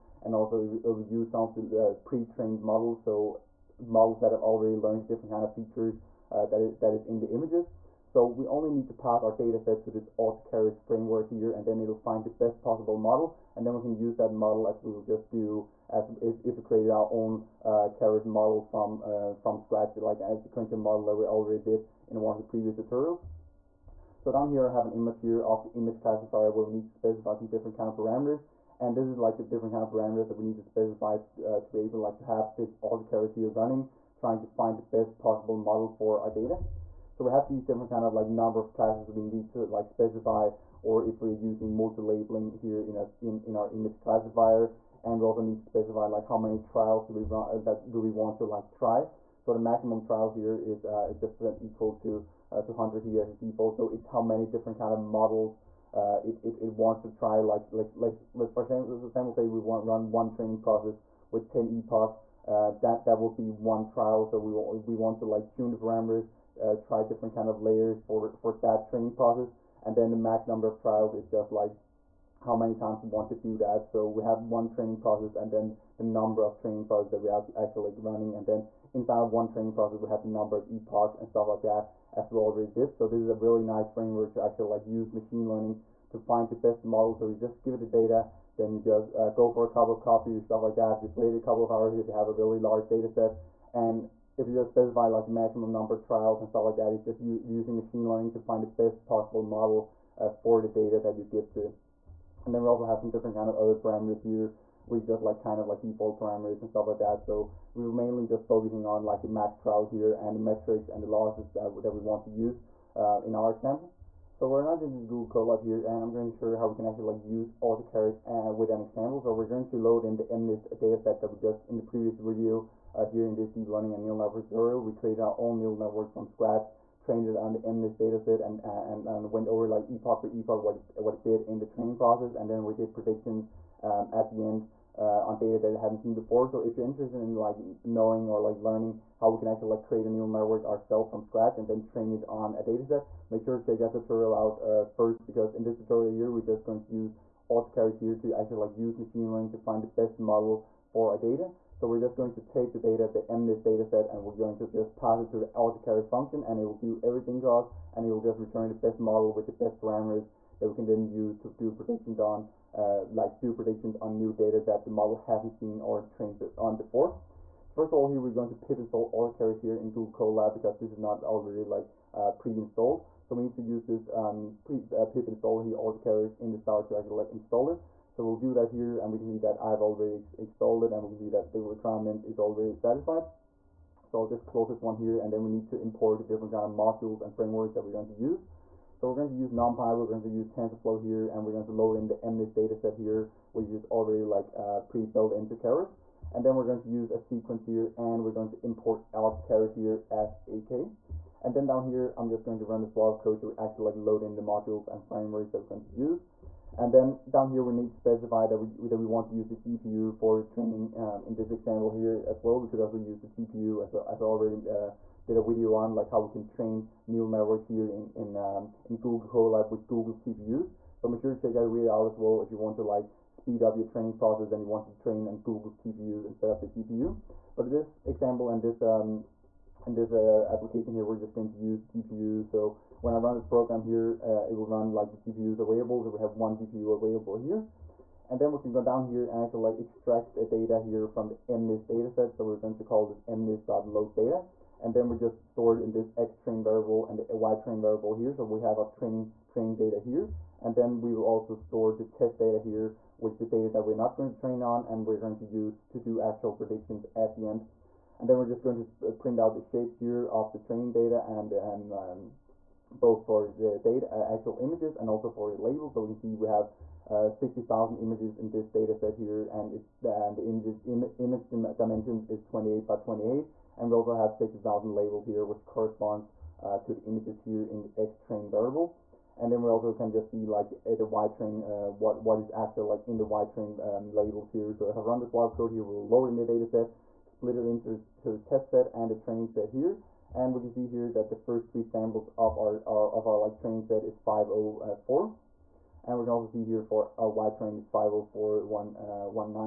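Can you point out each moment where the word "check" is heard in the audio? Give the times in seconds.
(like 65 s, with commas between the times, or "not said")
143 s, 221 s.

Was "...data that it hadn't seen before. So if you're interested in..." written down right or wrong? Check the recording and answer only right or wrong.
right.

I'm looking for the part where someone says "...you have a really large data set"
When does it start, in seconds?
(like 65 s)
92 s.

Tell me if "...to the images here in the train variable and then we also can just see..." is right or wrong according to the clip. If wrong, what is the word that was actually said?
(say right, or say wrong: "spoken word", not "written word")
right.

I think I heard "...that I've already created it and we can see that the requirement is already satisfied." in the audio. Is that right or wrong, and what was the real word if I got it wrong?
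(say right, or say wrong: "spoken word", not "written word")
wrong: "installed", not "created".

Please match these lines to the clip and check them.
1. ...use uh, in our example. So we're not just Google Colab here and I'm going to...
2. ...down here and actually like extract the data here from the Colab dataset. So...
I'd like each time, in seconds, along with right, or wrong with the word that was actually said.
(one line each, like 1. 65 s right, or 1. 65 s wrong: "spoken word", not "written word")
1. 112 s right
2. 238 s wrong: "MNIST", not "Colab".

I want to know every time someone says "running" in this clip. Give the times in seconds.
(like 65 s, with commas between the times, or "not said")
33 s, 78 s.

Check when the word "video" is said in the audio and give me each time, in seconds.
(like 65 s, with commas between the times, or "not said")
122 s, 215 s, 221 s.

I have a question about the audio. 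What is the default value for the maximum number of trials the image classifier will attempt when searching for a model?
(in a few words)
200.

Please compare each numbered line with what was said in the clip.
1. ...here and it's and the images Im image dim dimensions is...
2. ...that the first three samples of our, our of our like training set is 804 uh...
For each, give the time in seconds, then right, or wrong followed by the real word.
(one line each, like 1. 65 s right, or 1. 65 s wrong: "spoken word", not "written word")
1. 269 s right
2. 291 s wrong: "504", not "804".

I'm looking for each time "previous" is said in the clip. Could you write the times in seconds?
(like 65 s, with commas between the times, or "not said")
22 s, 121 s.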